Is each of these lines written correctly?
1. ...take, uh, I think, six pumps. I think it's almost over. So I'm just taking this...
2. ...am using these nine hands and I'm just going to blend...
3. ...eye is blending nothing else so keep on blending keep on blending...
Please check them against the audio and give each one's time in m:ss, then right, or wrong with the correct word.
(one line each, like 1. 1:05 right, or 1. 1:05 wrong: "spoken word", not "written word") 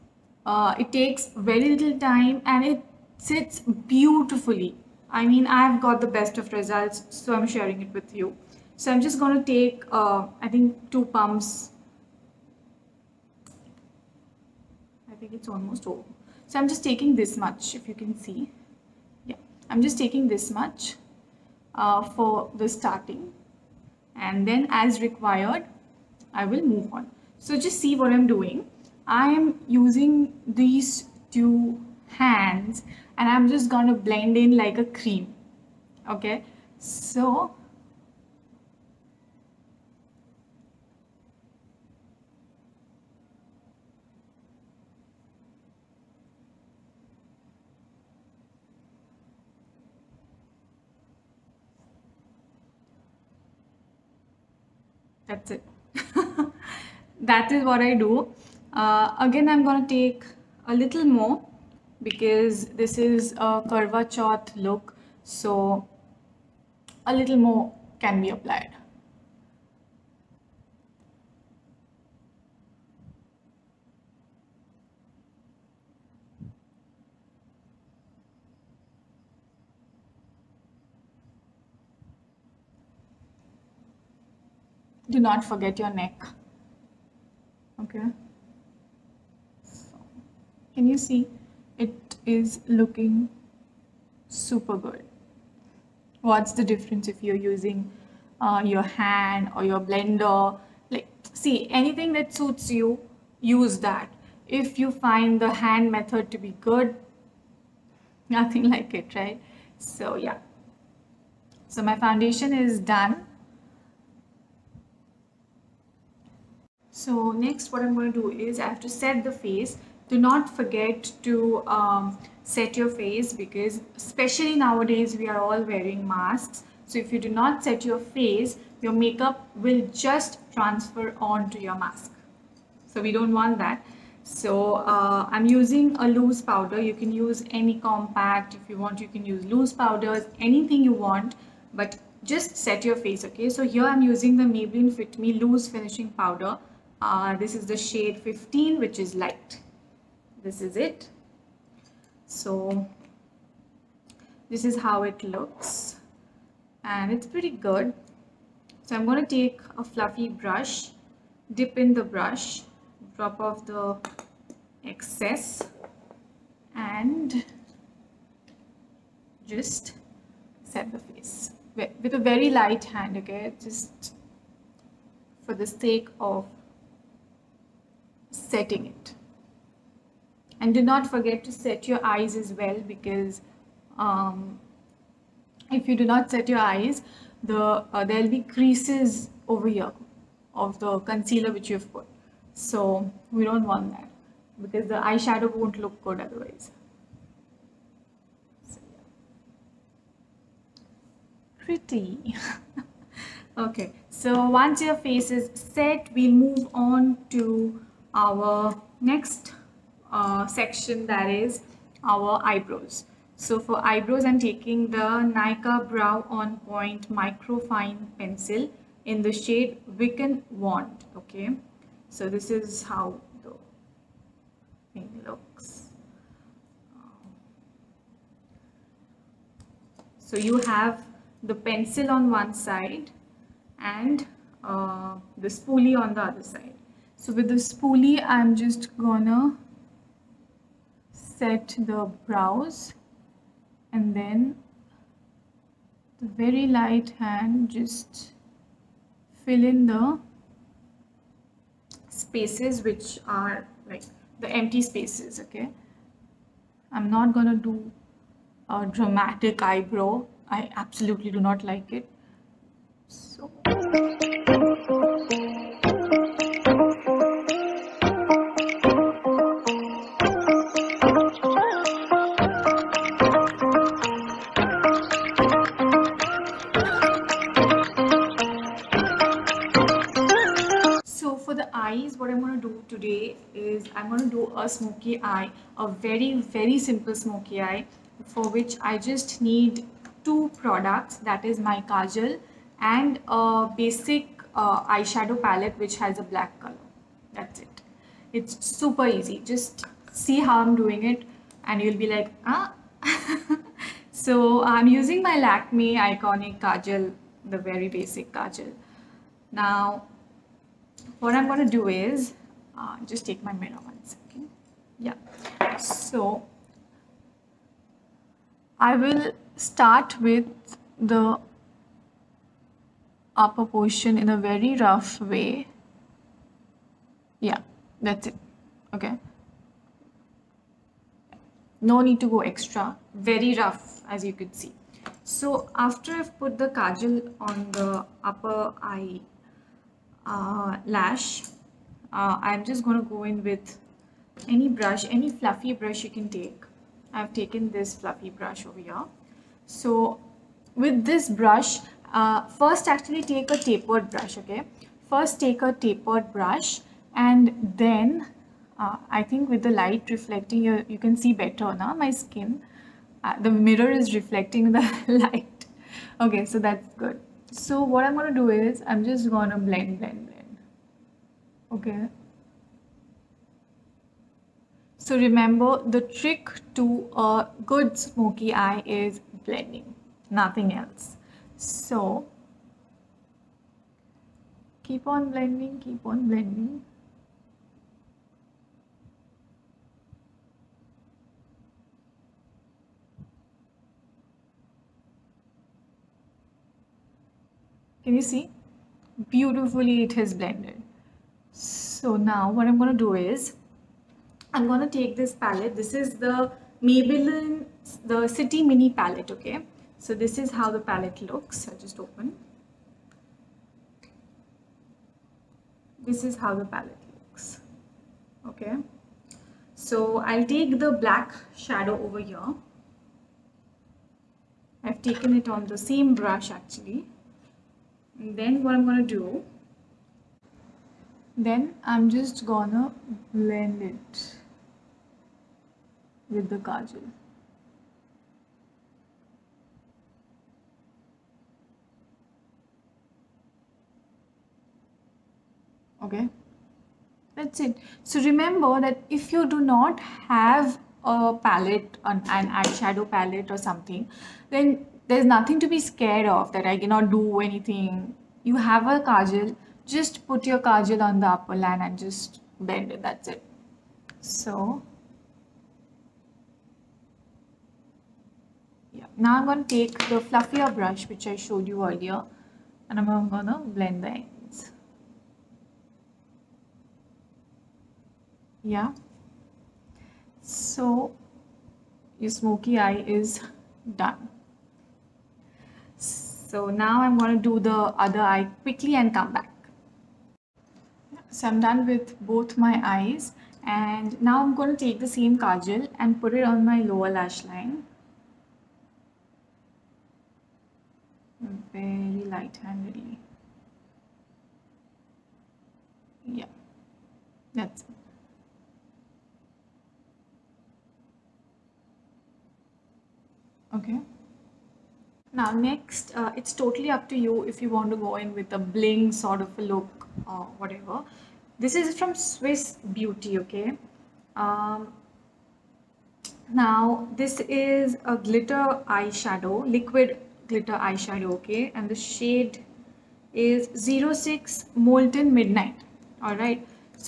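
1. 0:09 wrong: "two", not "six"
2. 0:29 wrong: "two", not "nine"
3. 6:18 right.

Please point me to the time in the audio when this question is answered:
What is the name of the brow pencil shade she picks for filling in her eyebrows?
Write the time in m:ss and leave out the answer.
3:39.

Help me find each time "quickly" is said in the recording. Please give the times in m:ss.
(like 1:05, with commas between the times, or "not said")
8:08.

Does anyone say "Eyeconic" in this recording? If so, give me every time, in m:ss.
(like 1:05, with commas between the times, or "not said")
5:05.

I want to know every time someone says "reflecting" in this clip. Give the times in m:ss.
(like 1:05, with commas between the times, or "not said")
6:00, 6:04.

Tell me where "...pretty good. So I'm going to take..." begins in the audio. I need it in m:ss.
2:37.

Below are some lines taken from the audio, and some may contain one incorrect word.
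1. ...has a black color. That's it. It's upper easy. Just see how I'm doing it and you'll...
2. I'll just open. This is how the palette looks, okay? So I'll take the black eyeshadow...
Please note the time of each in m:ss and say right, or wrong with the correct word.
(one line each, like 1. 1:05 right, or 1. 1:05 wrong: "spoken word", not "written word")
1. 4:55 wrong: "super", not "upper"
2. 6:51 wrong: "shadow", not "eyeshadow".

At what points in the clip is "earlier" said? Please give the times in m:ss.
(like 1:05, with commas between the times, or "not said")
7:51.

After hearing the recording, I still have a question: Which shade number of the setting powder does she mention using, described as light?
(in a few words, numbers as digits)
15.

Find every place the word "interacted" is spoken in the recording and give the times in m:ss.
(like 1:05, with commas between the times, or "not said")
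not said.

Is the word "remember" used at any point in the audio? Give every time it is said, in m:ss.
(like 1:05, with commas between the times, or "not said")
6:15, 7:28.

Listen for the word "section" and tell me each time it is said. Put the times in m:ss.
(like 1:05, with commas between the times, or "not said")
3:30.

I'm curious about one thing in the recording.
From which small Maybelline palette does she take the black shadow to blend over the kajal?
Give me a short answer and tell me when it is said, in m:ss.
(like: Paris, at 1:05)
City Mini palette, at 6:48.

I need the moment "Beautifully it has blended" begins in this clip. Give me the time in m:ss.
6:39.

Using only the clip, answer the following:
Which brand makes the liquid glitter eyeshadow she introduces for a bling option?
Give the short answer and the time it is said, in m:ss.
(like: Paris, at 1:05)
Swiss Beauty, at 8:42.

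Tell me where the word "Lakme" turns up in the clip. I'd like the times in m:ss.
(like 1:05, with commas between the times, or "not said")
5:05.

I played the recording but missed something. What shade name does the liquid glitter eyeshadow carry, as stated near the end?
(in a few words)
06 Molten Midnight.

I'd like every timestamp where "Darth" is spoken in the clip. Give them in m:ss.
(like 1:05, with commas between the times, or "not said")
not said.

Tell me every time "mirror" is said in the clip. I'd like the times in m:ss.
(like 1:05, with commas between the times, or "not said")
5:13, 6:03.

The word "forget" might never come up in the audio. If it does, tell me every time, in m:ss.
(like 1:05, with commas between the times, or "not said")
1:25, 2:00, 3:01.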